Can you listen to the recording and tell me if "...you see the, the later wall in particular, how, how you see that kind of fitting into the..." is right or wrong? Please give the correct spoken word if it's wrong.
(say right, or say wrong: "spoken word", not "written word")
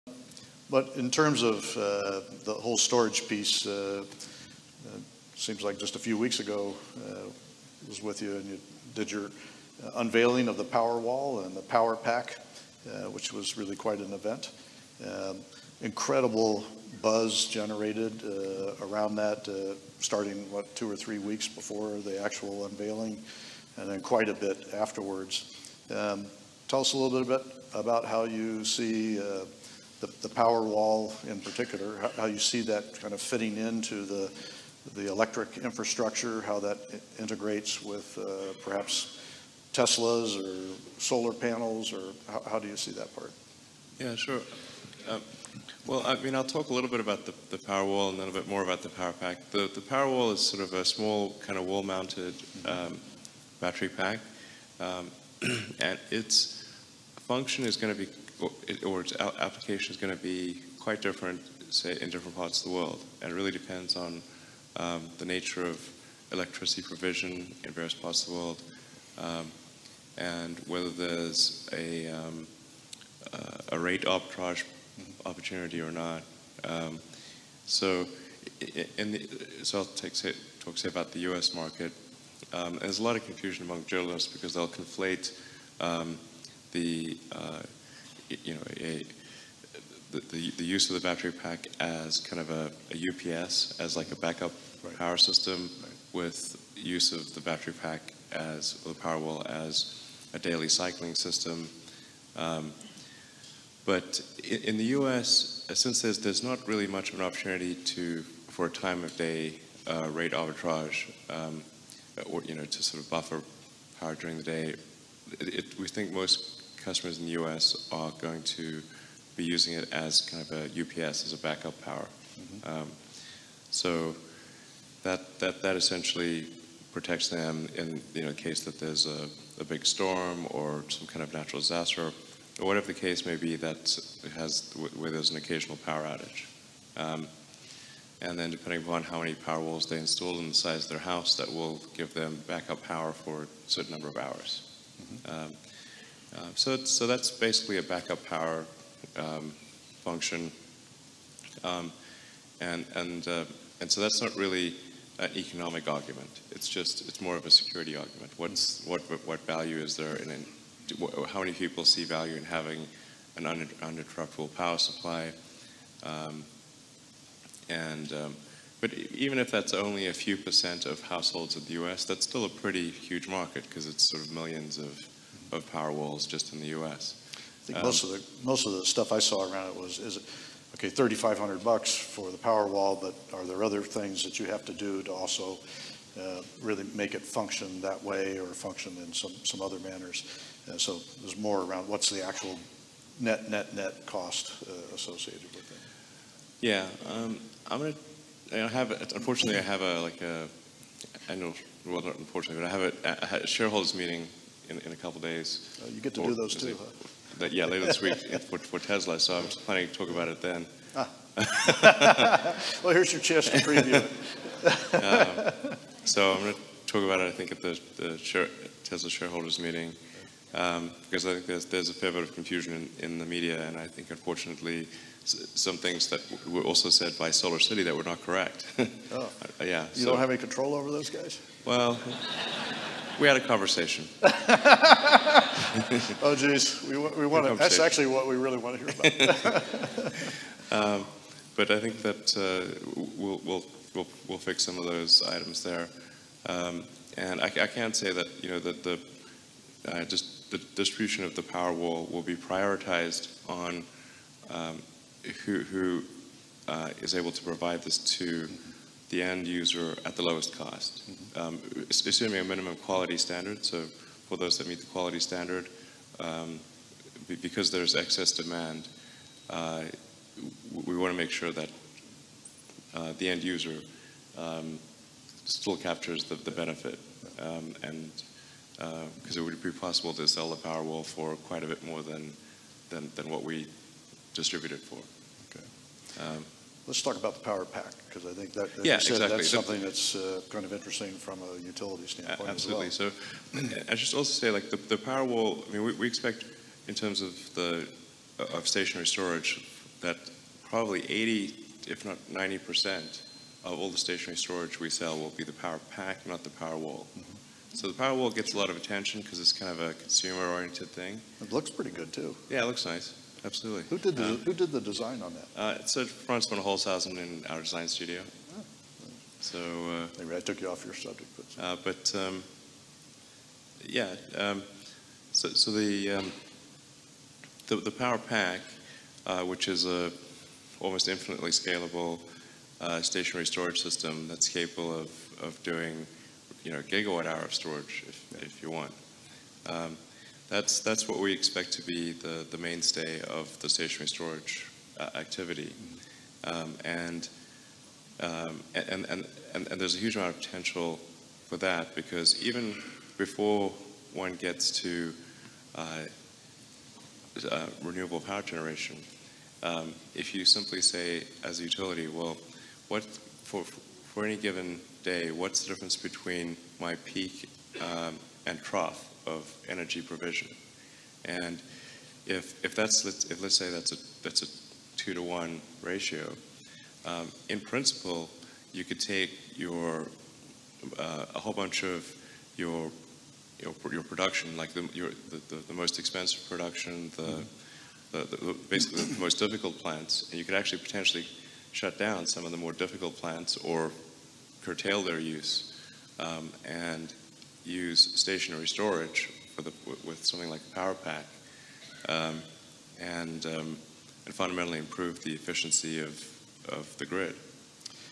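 wrong: "power", not "later".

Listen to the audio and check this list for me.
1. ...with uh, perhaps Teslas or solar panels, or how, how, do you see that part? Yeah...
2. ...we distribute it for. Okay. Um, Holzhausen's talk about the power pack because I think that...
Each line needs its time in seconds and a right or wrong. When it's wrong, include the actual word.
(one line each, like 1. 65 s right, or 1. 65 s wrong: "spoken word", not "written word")
1. 37 s right
2. 283 s wrong: "Let", not "Holzhausen".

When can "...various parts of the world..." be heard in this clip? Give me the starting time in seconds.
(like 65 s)
67 s.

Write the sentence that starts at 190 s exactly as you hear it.
Uh, so there's more around what's the actual net net net cost uh, associated with it.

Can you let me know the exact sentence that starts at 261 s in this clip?
um, assuming a minimum quality standard.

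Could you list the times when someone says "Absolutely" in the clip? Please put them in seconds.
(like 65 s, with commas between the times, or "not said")
292 s, 313 s.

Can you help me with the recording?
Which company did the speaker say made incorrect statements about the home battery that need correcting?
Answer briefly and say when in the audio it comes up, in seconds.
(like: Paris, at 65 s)
Solar City, at 227 s.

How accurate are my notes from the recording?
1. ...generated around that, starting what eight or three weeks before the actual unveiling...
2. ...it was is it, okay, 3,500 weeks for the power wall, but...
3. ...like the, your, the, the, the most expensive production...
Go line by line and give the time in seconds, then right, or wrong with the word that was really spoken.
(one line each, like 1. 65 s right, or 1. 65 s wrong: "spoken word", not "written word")
1. 17 s wrong: "two", not "eight"
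2. 179 s wrong: "bucks", not "weeks"
3. 384 s right.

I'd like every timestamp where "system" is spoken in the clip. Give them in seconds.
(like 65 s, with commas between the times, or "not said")
95 s, 101 s, 333 s.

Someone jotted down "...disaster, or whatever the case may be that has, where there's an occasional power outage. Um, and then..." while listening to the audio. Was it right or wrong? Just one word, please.
right.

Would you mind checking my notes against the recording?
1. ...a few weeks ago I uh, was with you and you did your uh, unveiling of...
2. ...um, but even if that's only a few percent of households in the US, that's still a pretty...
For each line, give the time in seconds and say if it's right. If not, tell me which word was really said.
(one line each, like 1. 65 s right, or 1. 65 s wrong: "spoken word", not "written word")
1. 5 s right
2. 168 s right.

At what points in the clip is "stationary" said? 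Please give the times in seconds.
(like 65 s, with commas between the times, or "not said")
298 s, 303 s, 333 s, 343 s, 398 s.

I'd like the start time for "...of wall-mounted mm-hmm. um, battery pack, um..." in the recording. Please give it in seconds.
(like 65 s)
51 s.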